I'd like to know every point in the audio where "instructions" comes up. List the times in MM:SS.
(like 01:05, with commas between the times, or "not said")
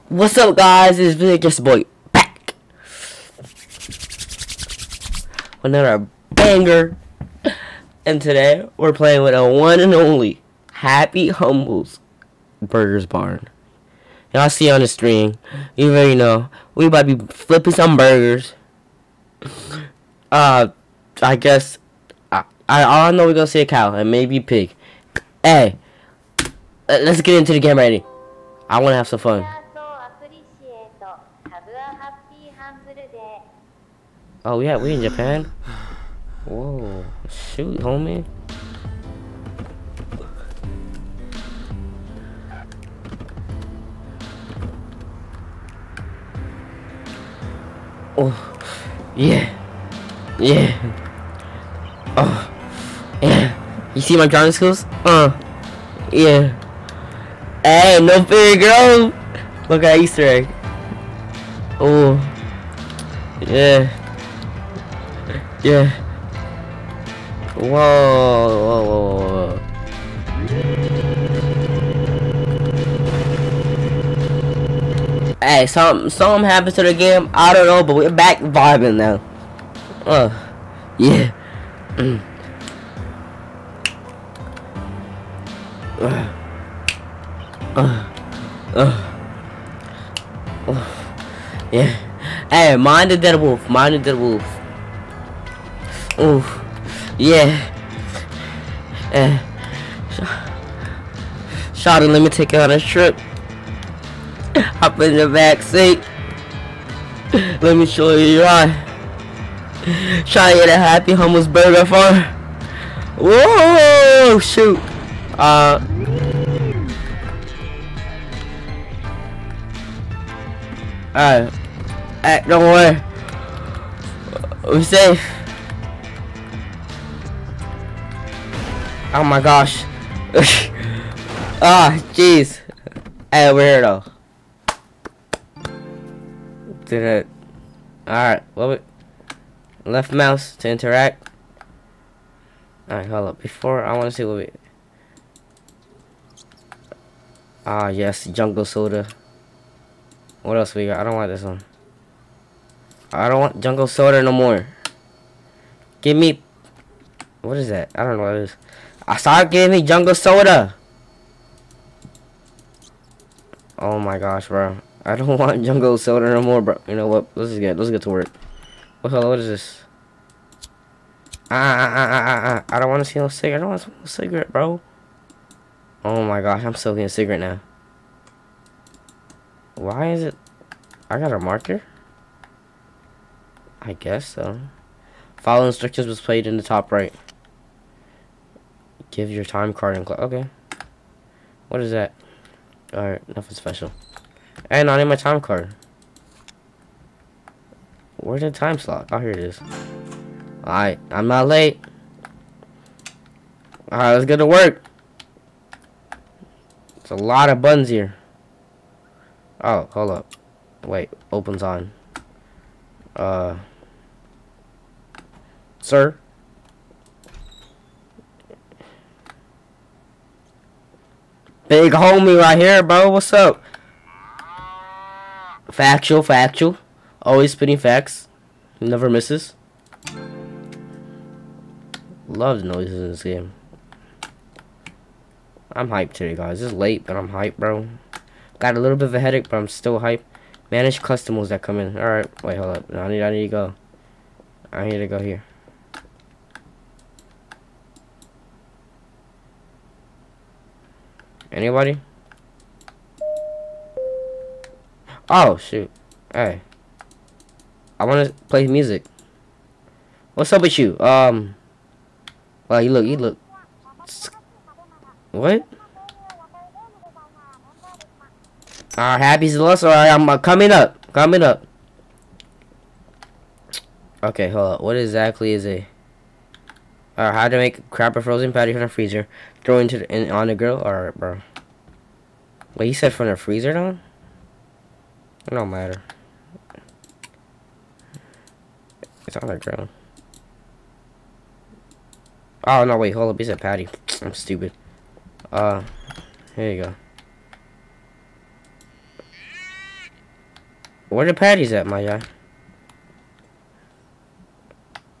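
03:05.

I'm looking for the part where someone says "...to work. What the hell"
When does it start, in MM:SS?
02:48.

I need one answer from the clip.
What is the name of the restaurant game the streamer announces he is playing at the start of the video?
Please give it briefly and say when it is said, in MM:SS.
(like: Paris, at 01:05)
Happy Humbles Burgers Barn, at 00:10.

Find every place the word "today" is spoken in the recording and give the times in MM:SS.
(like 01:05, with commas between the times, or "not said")
00:08, 03:56.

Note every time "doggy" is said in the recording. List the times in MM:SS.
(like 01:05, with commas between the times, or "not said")
not said.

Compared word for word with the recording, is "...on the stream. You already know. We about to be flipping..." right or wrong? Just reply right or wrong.
right.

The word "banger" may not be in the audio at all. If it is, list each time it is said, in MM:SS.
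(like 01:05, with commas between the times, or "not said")
00:06.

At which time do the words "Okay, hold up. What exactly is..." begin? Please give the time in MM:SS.
04:34.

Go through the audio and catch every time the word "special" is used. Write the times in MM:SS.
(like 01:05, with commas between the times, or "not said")
03:13.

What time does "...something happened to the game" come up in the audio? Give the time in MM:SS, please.
01:16.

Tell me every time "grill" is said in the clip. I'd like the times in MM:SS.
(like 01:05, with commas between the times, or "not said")
04:40, 04:49.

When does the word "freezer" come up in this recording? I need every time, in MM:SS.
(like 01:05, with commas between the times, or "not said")
04:38, 04:43.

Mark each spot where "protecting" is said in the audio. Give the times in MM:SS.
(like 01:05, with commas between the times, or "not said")
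not said.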